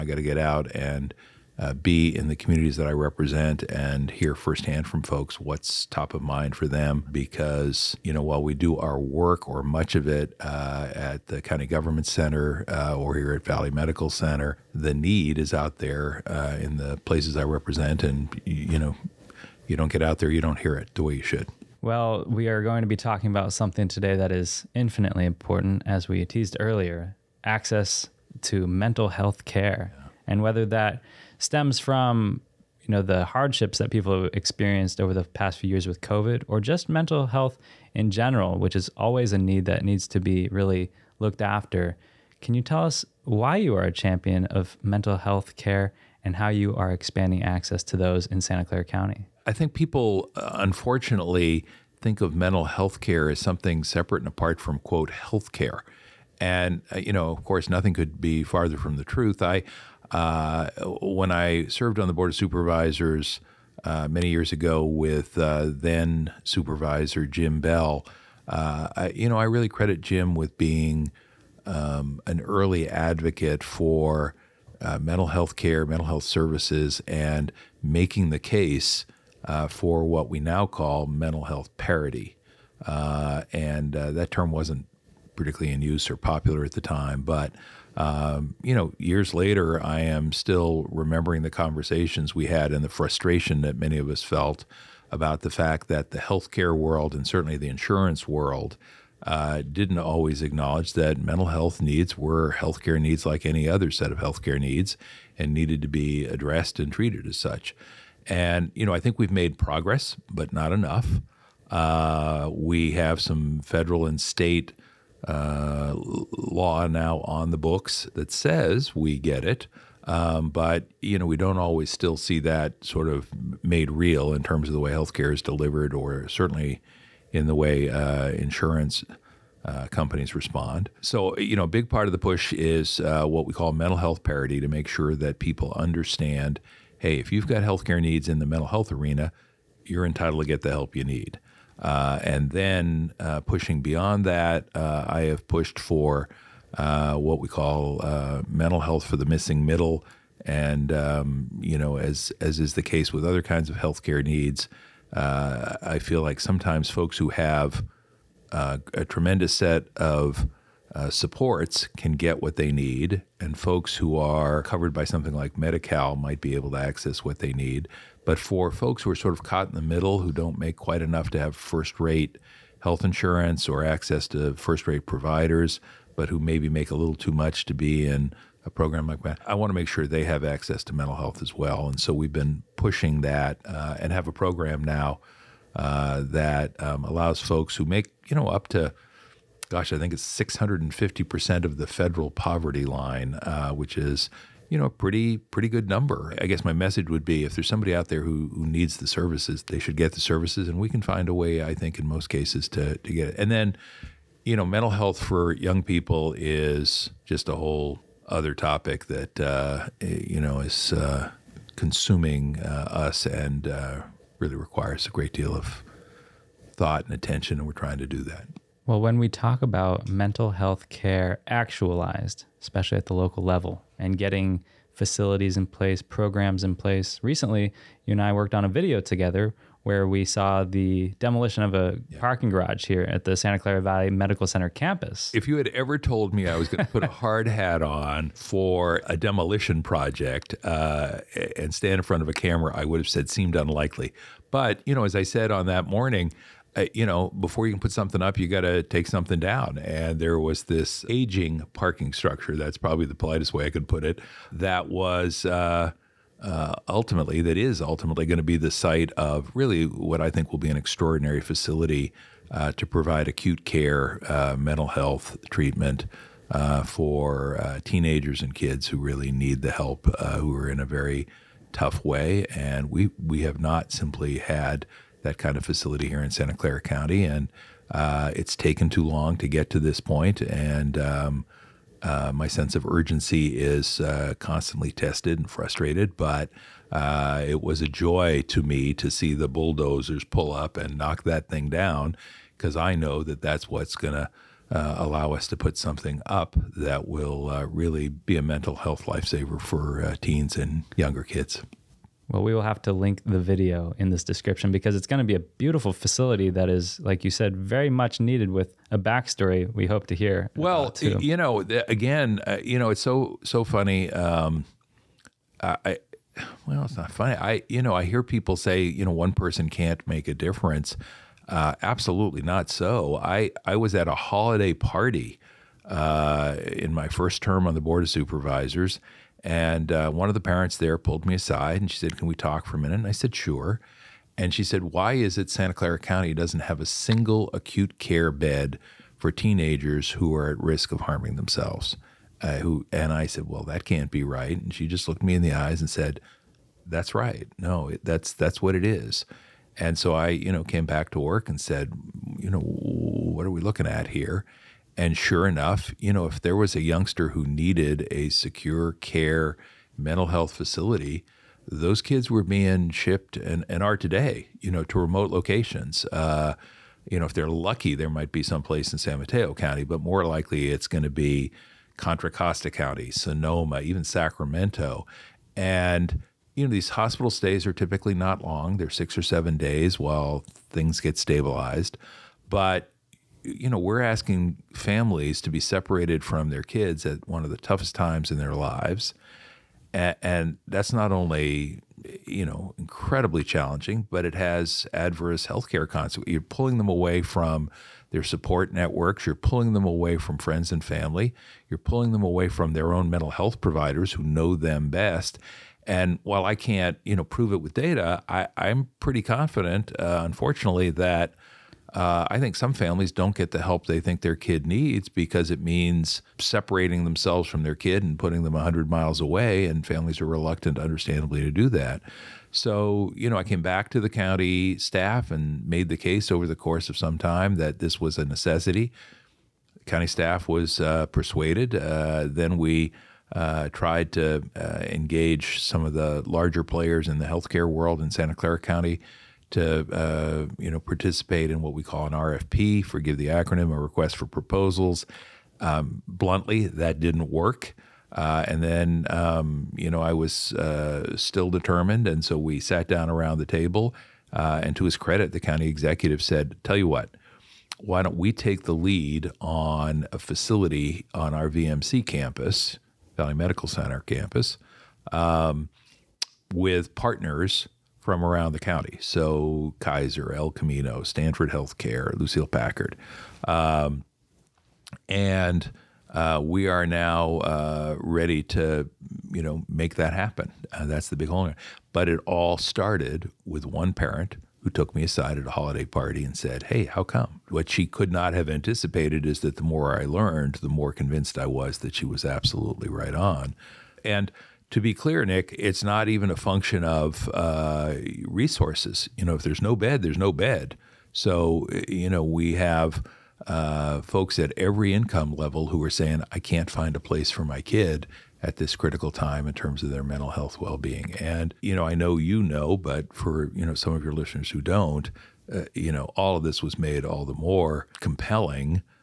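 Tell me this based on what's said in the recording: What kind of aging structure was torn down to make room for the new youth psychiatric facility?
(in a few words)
parking garage.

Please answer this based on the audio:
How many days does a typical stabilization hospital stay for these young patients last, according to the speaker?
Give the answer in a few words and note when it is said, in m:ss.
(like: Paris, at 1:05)
6 or 7 days, at 6:18.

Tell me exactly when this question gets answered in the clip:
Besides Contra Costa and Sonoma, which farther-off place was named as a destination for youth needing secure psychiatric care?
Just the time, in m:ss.
6:14.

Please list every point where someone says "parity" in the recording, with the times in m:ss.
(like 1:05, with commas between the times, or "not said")
1:21, 2:14.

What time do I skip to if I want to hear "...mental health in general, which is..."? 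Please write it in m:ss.
0:36.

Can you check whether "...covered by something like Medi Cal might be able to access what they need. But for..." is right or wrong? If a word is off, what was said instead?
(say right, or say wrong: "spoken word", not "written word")
right.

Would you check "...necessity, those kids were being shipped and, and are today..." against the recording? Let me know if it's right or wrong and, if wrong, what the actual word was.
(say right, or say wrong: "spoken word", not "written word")
wrong: "facility", not "necessity".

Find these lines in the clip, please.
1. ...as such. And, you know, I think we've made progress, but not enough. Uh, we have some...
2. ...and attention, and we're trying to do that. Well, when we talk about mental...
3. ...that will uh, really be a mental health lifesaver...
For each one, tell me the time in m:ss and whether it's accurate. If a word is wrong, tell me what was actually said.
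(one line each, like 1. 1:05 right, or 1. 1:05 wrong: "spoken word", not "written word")
1. 1:47 right
2. 3:37 right
3. 4:56 right.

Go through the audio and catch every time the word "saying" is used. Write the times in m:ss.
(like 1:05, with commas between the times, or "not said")
8:25.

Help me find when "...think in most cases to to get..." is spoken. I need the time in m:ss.
3:21.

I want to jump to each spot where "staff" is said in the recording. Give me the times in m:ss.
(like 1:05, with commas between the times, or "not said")
7:04, 7:10.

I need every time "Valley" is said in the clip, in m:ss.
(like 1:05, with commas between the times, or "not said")
0:13, 3:53, 7:43.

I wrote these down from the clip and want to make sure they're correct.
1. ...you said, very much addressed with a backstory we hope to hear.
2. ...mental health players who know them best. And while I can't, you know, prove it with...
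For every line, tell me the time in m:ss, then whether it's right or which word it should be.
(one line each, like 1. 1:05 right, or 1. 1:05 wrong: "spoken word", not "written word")
1. 5:07 wrong: "needed", not "addressed"
2. 6:43 wrong: "providers", not "players".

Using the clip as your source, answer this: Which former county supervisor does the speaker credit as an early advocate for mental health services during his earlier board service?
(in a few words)
Jim Beall.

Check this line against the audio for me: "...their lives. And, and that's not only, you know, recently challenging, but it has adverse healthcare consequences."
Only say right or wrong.
wrong.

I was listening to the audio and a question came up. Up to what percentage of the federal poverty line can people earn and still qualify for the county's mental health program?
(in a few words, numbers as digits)
650%.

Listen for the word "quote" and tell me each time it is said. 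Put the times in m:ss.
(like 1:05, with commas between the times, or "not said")
0:54.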